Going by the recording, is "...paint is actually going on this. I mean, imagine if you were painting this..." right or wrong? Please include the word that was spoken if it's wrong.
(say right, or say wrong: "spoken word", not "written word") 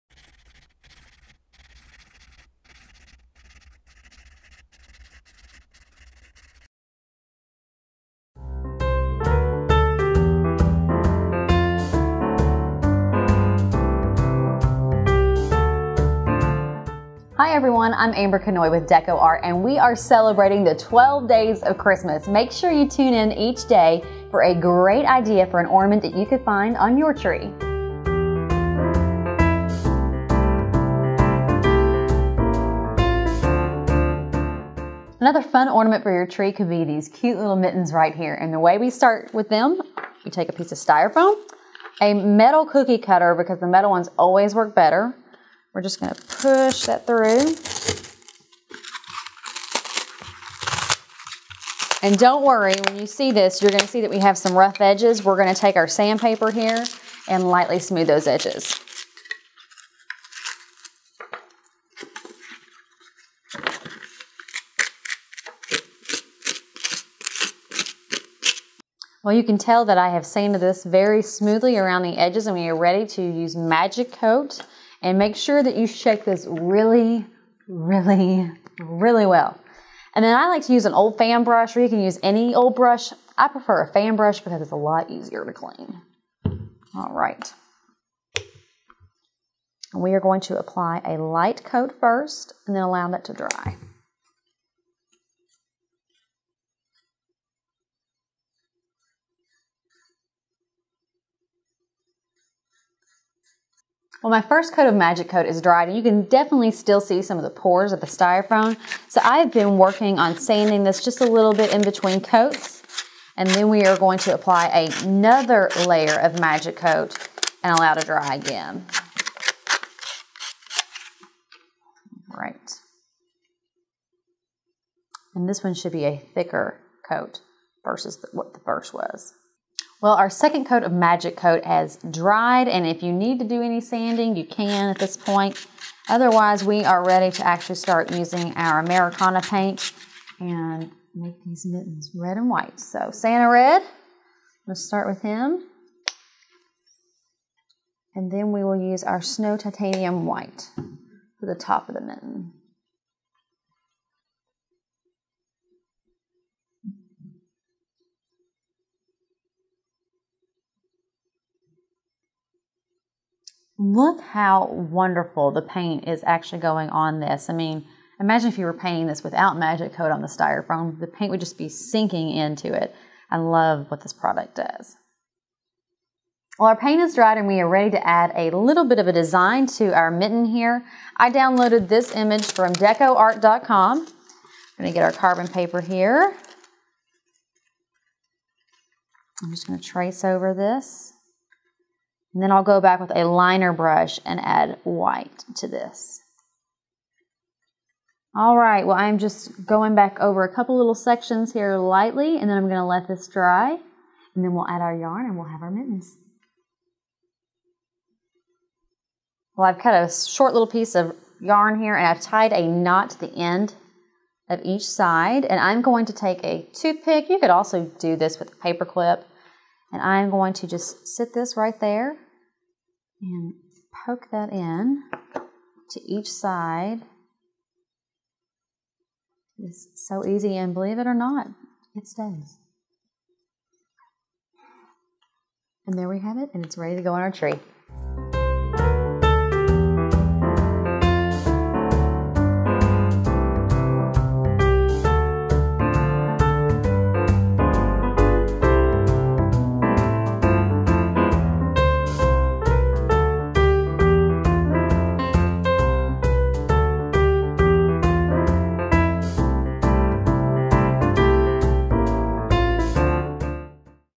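right.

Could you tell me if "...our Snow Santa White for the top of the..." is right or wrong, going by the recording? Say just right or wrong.
wrong.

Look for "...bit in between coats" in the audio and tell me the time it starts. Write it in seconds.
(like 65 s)
111 s.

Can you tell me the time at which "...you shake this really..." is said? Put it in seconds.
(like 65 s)
75 s.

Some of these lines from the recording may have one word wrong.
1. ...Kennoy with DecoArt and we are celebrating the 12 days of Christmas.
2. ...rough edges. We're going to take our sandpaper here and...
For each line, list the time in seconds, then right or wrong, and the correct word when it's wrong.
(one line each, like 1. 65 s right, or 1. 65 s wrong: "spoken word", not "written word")
1. 18 s right
2. 54 s right.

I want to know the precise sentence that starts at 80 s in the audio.
And then I like to use an old fan brush, or you can use any old brush.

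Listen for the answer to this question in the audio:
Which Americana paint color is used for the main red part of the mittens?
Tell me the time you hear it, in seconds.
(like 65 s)
143 s.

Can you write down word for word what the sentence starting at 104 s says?
Well, my first coat of MagiKote is dried and you can definitely still see some of the pores of the styrofoam.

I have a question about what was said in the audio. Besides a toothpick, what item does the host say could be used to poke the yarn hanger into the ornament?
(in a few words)
Paper clip.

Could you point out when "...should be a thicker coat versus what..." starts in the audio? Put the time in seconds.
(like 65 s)
125 s.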